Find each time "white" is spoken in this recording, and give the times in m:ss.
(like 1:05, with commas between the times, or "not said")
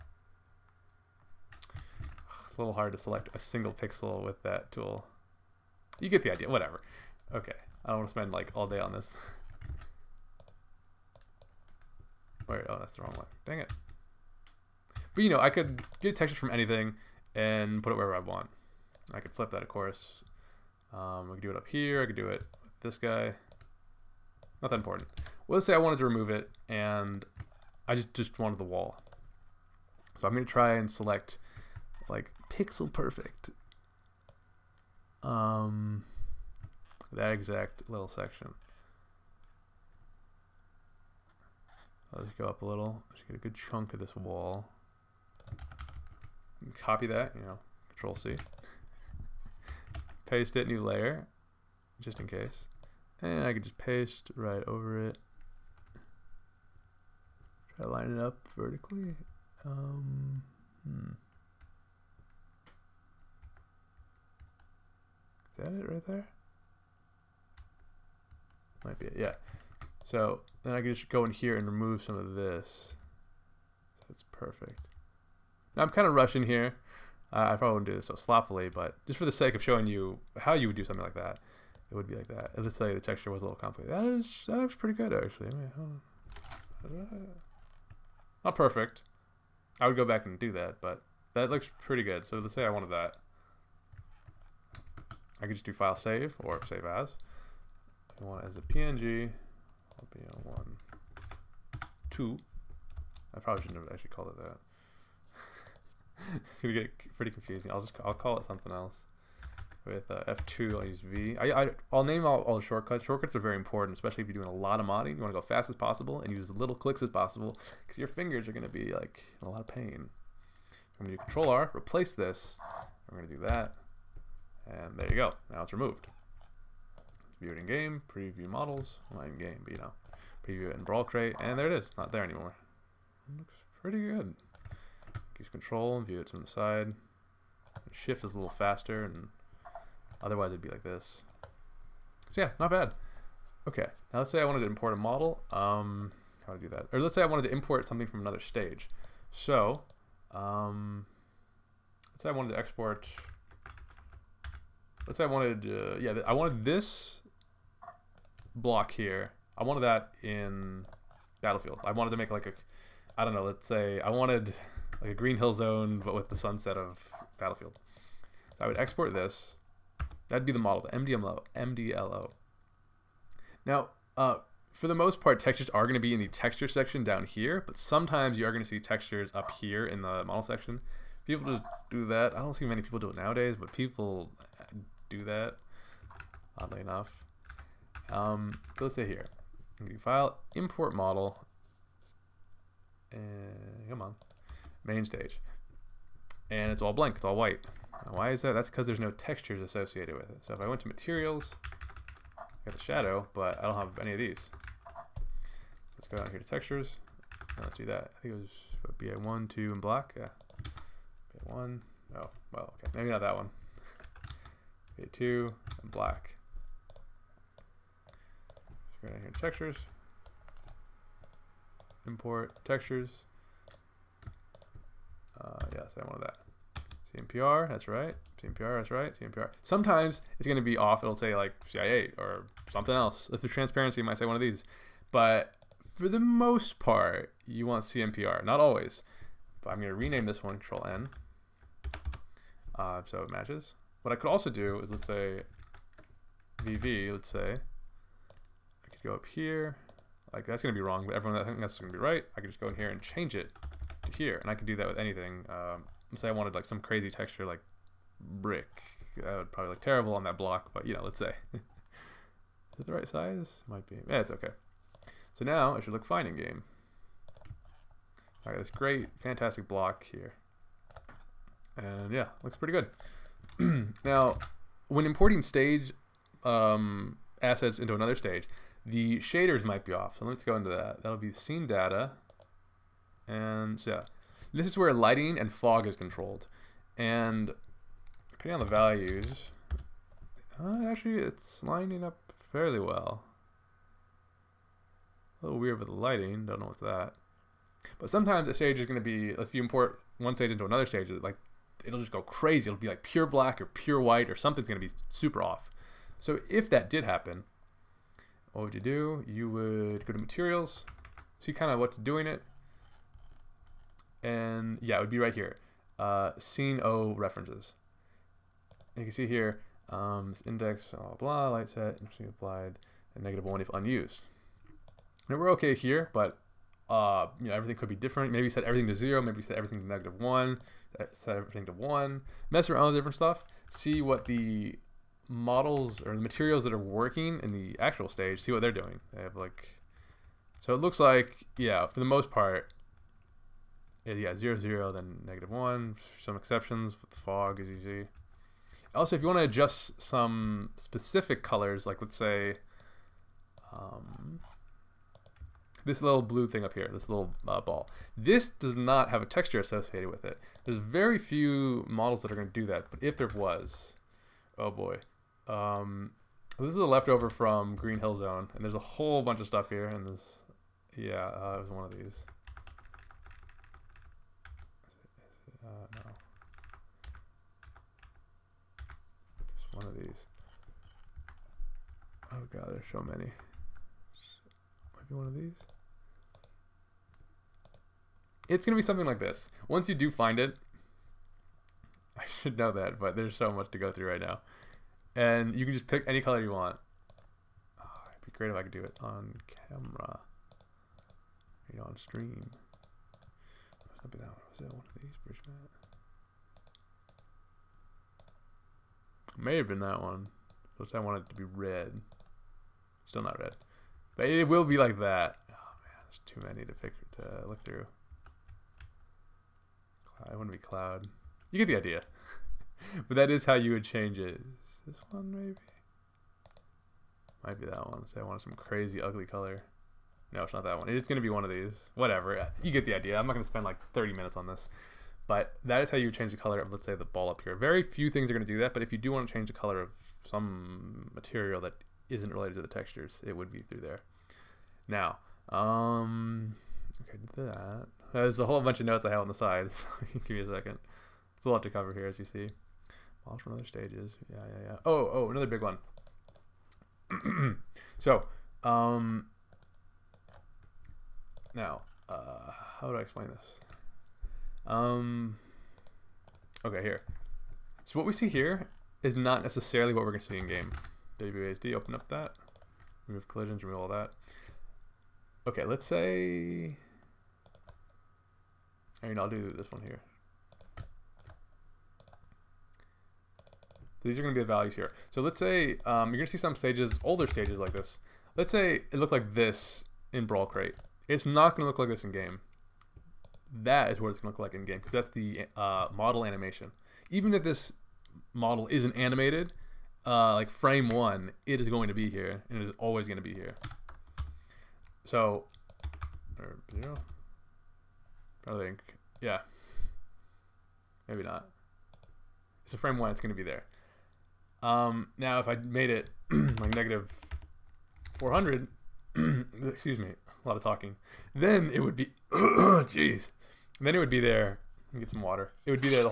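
3:17, 5:04.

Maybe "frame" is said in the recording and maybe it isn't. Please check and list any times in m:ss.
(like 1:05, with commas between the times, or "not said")
8:20, 8:32.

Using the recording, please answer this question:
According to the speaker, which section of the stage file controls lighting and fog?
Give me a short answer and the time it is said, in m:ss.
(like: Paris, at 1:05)
scene data, at 4:41.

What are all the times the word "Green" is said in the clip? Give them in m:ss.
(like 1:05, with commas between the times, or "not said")
2:45, 6:07.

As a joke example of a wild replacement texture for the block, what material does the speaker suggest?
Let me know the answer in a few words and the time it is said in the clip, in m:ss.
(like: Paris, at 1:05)
brick, at 4:18.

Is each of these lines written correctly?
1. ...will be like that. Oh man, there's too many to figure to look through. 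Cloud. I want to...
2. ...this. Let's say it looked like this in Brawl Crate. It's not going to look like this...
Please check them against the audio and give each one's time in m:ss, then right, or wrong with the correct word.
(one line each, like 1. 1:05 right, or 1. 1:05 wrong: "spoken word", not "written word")
1. 6:54 right
2. 8:07 right.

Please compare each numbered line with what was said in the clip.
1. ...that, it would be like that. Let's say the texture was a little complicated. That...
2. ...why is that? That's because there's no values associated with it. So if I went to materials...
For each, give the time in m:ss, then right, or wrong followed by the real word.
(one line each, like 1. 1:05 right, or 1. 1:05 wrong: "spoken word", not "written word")
1. 1:21 right
2. 3:18 wrong: "textures", not "values".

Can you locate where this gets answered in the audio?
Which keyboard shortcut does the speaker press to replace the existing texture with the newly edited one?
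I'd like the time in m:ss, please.
2:01.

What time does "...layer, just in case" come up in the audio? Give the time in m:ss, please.
0:50.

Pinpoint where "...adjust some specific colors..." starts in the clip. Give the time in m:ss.
5:49.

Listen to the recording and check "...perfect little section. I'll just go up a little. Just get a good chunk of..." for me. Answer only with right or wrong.
wrong.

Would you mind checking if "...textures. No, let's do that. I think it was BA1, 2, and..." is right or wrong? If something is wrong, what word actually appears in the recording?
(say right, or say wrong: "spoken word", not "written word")
right.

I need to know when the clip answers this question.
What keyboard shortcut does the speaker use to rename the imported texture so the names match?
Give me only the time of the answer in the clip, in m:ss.
4:00.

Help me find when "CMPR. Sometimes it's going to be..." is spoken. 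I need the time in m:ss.
3:49.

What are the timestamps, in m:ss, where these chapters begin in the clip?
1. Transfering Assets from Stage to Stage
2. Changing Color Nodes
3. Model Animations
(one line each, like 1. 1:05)
1. 2:29
2. 5:48
3. 7:48.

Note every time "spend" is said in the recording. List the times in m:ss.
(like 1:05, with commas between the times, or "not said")
0:08, 7:13.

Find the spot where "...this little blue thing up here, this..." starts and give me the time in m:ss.
5:55.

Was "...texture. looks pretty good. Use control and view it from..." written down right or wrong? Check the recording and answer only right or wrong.
wrong.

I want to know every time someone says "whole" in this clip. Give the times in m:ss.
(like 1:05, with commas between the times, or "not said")
6:08, 7:28.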